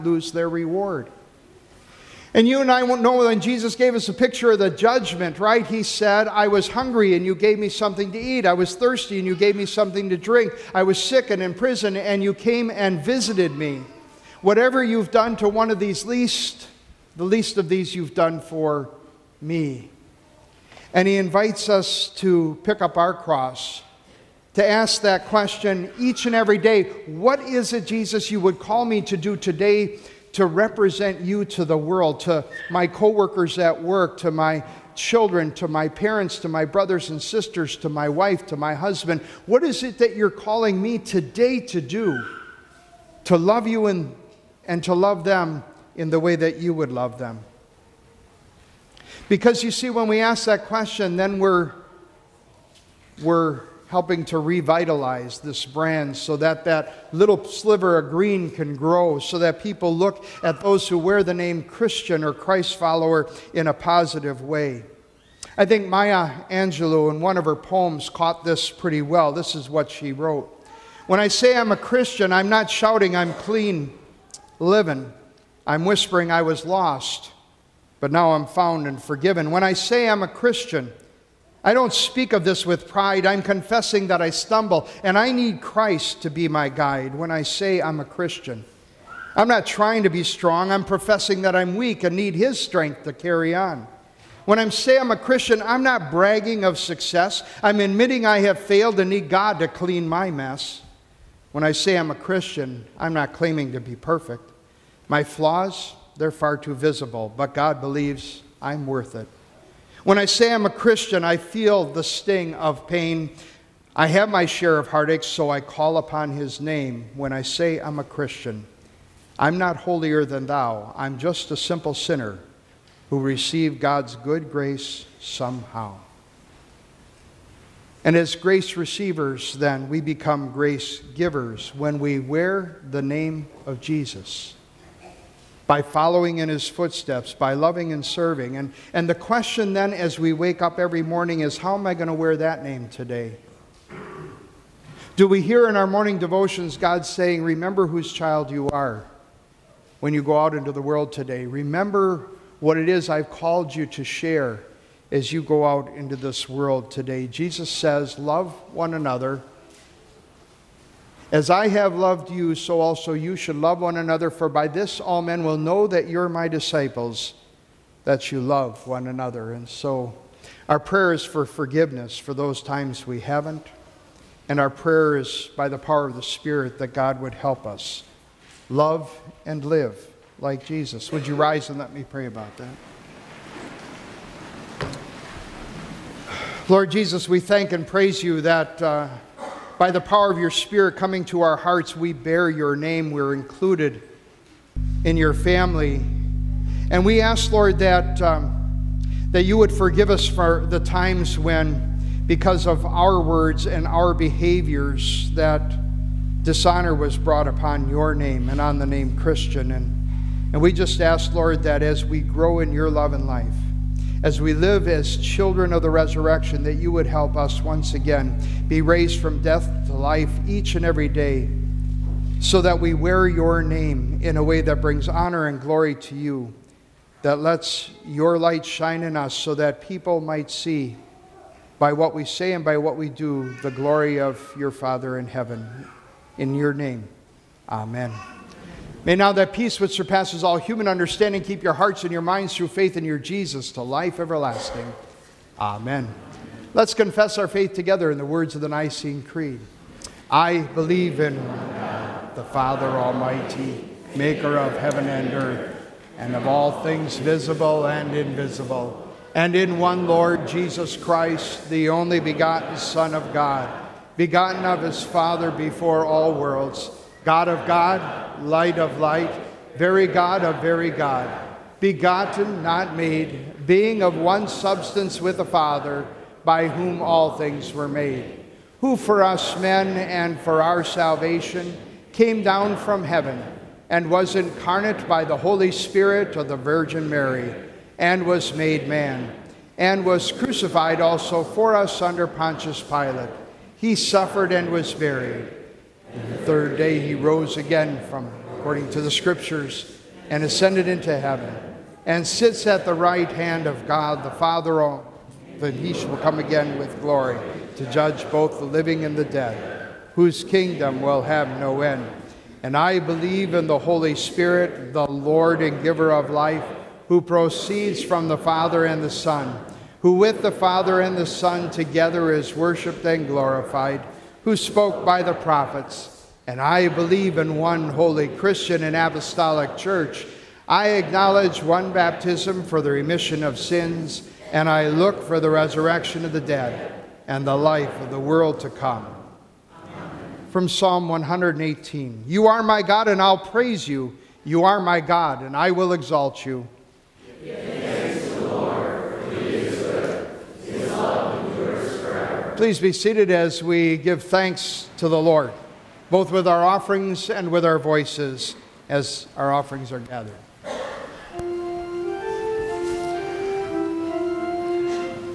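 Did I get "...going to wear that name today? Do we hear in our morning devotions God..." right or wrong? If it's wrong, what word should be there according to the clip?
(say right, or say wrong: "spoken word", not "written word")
right.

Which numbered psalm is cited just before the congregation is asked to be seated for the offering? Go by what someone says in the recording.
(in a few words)
Psalm 118.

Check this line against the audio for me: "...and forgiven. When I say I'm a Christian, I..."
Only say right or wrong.
right.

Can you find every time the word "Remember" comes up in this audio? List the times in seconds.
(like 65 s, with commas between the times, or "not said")
147 s, 151 s.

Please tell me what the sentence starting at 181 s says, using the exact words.
Would you rise and let me pray about that?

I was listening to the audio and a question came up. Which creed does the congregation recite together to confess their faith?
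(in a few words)
Nicene Creed.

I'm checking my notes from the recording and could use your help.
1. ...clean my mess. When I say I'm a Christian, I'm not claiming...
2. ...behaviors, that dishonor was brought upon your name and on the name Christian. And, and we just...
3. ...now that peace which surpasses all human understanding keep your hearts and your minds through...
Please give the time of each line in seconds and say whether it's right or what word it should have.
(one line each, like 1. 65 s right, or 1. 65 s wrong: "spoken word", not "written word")
1. 99 s right
2. 204 s right
3. 239 s right.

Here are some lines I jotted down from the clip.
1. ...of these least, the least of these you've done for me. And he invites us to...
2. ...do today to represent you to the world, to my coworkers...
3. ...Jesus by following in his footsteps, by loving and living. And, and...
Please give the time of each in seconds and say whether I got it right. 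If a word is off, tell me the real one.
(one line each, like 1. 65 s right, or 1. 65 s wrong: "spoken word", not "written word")
1. 15 s right
2. 29 s right
3. 133 s wrong: "serving", not "living".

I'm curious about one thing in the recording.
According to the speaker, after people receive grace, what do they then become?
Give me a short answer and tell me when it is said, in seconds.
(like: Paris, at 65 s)
grace givers, at 130 s.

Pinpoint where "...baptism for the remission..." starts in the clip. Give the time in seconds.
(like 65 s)
331 s.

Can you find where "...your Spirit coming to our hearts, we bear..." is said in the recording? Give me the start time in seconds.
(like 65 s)
190 s.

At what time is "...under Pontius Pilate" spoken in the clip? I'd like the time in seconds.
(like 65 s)
292 s.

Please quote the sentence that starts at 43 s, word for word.
To love you and, and to love them in the way that you would love them.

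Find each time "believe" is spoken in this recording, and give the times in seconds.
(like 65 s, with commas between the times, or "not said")
107 s, 250 s, 312 s, 326 s.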